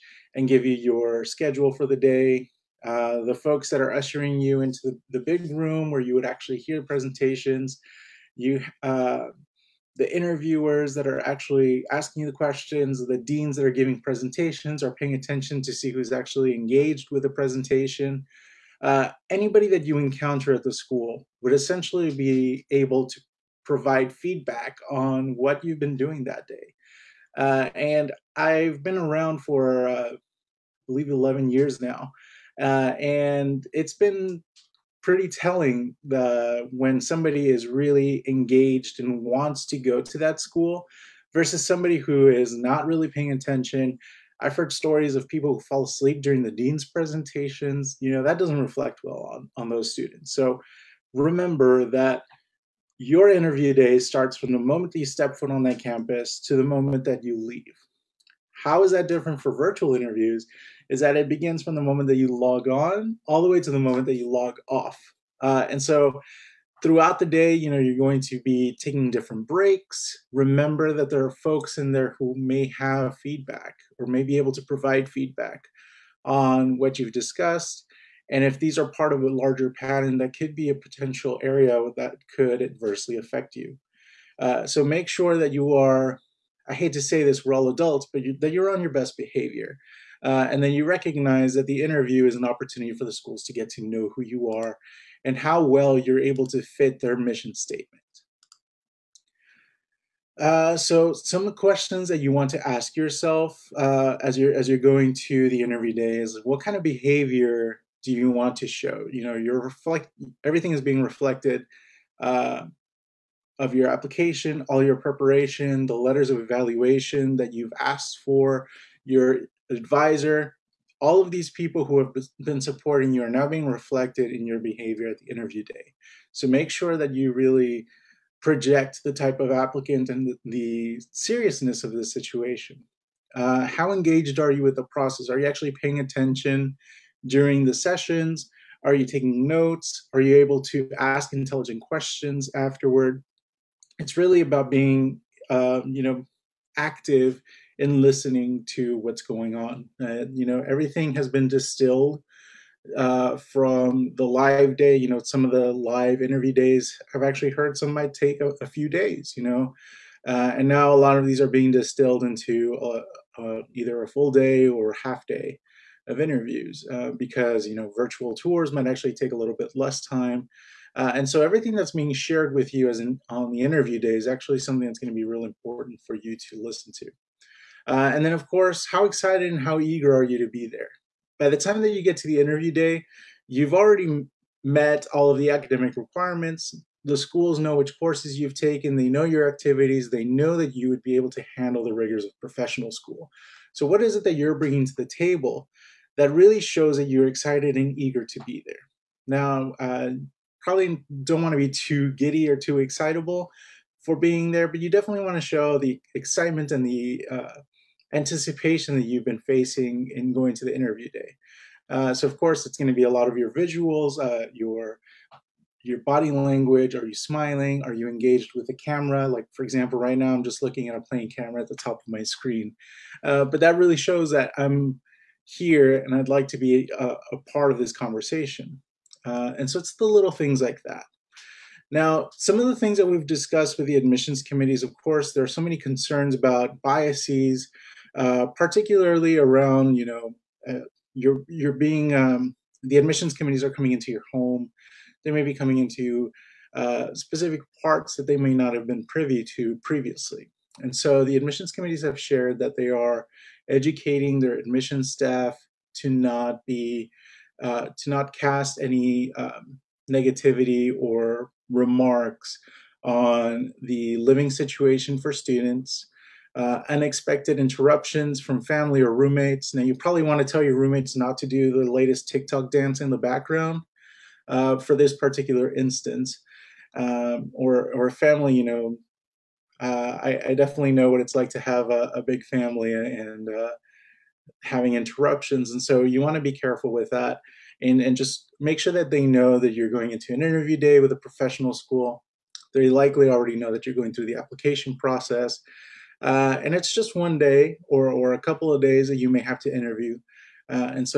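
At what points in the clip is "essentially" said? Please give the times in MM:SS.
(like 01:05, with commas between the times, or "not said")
00:21.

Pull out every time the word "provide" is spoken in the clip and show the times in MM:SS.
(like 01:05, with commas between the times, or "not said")
00:23, 01:14.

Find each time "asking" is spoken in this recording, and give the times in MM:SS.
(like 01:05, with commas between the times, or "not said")
00:11.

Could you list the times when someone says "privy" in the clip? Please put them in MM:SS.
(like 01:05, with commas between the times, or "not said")
04:09.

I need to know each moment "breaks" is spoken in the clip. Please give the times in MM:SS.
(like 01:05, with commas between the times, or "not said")
01:09.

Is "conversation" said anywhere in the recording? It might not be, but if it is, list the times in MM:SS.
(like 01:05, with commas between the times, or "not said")
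03:47.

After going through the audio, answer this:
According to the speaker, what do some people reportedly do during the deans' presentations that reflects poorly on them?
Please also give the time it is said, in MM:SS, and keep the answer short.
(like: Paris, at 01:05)
fall asleep, at 00:45.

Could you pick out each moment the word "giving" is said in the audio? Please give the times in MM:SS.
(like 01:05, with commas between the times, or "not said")
00:13.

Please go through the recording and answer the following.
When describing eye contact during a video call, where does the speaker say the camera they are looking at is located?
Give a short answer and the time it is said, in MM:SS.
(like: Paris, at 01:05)
top of my screen, at 03:41.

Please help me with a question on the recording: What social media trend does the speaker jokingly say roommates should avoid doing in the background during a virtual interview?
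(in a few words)
the latest TikTok dance.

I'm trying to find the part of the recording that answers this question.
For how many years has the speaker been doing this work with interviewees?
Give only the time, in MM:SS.
00:31.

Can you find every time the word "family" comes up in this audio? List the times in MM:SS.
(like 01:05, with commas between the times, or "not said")
04:28, 04:38, 04:42.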